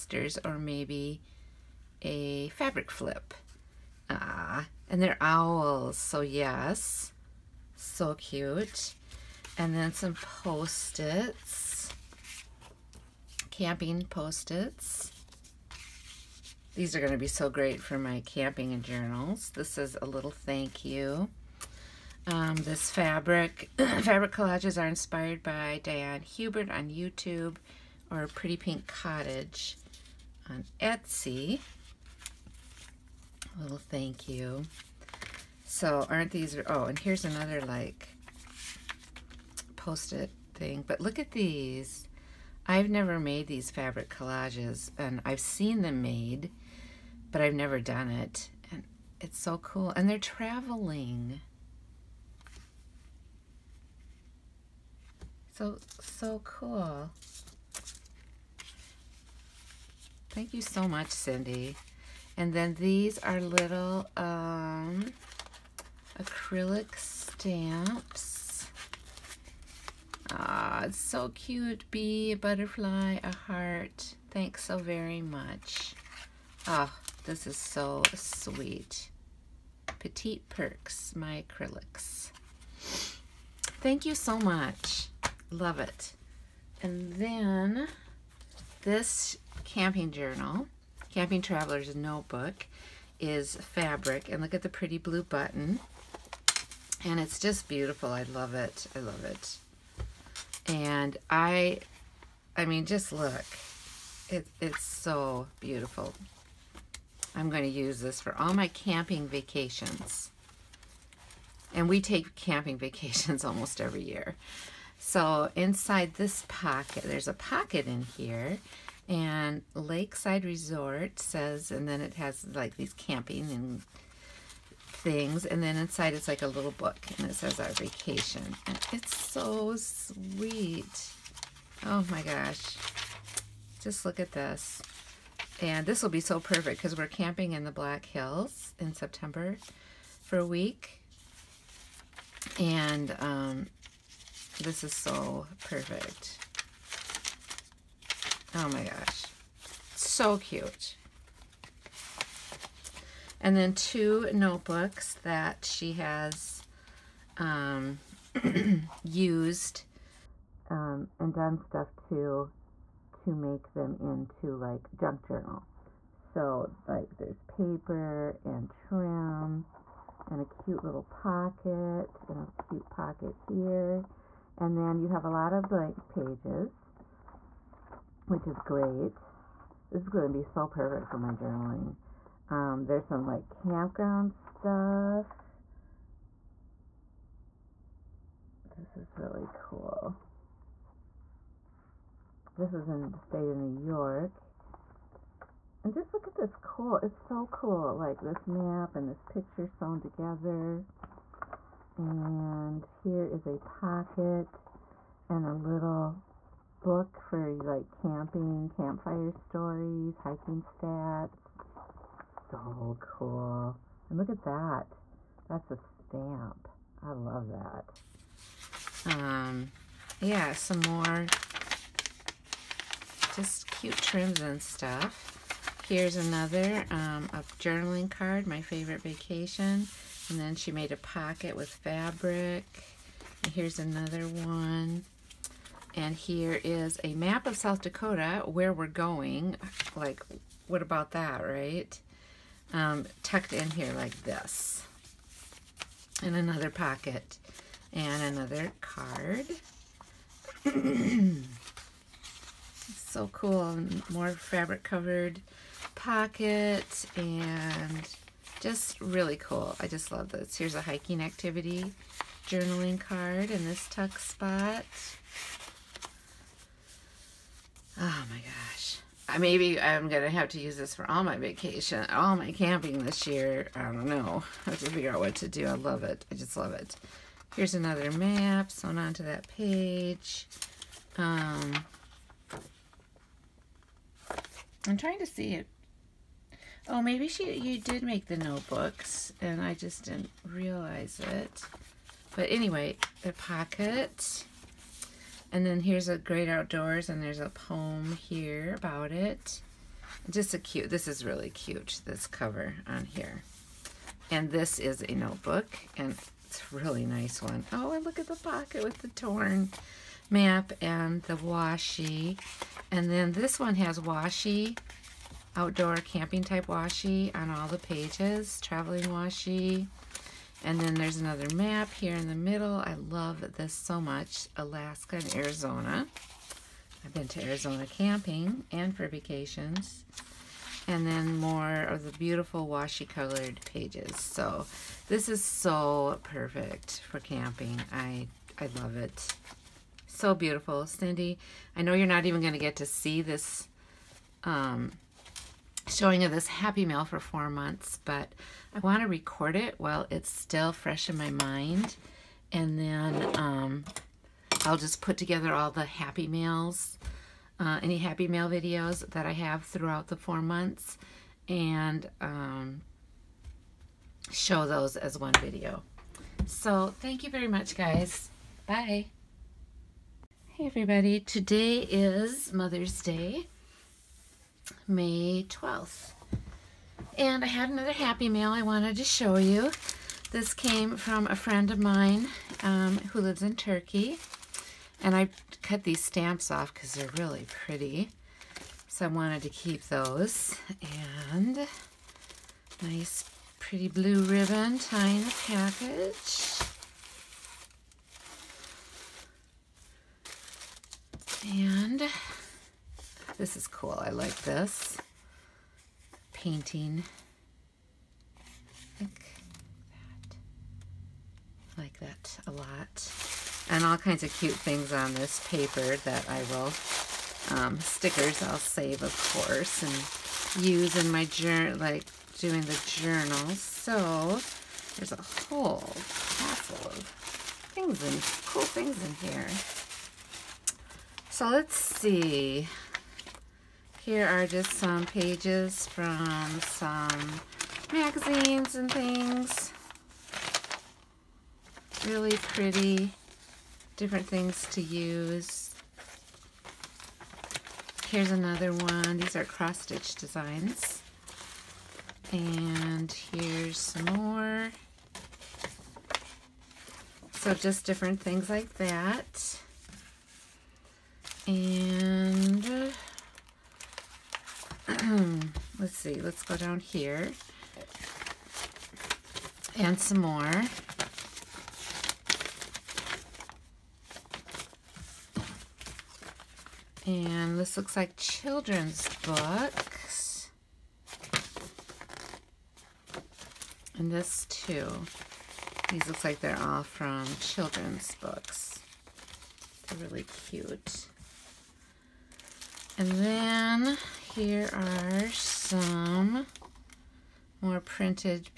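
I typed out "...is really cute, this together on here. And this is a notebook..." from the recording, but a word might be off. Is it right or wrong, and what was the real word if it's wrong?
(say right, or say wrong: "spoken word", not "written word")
wrong: "cover", not "together".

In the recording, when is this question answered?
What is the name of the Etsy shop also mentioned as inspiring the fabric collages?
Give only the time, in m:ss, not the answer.
0:28.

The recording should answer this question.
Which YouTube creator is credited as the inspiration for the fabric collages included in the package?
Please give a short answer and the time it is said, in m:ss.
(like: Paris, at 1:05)
Diane Hubert, at 0:25.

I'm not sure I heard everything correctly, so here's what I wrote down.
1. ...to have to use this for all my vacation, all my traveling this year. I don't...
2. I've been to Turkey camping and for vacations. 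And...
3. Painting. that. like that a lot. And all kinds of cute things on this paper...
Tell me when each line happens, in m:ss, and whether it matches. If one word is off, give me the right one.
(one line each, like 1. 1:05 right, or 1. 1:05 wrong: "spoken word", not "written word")
1. 4:30 wrong: "camping", not "traveling"
2. 5:27 wrong: "Arizona", not "Turkey"
3. 6:46 right.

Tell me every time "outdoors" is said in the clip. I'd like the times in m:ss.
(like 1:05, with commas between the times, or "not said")
4:56, 5:15.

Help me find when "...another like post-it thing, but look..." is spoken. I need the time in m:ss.
0:37.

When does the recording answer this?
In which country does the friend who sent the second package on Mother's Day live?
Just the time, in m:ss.
6:23.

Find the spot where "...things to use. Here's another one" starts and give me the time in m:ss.
7:24.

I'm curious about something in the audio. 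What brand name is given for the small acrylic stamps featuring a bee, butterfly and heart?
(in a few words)
Petite Perks.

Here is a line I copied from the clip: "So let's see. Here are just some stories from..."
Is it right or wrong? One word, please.
wrong.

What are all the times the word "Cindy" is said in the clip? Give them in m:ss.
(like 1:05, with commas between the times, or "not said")
1:01, 5:40.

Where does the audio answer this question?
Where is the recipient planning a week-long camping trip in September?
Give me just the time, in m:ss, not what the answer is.
2:17.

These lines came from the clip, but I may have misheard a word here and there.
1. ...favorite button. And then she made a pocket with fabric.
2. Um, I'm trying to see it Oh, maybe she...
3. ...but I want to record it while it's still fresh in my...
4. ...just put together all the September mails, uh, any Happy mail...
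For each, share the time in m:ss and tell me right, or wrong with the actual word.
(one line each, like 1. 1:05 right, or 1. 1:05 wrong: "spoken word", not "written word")
1. 3:48 wrong: "vacation", not "button"
2. 4:41 right
3. 5:48 right
4. 5:54 wrong: "Happy", not "September".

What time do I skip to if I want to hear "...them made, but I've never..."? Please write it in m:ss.
0:45.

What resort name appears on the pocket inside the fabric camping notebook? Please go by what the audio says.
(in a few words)
Lakeside Resort.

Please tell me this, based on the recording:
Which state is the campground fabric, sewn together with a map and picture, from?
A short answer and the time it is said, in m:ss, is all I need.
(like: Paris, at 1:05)
New York, at 3:13.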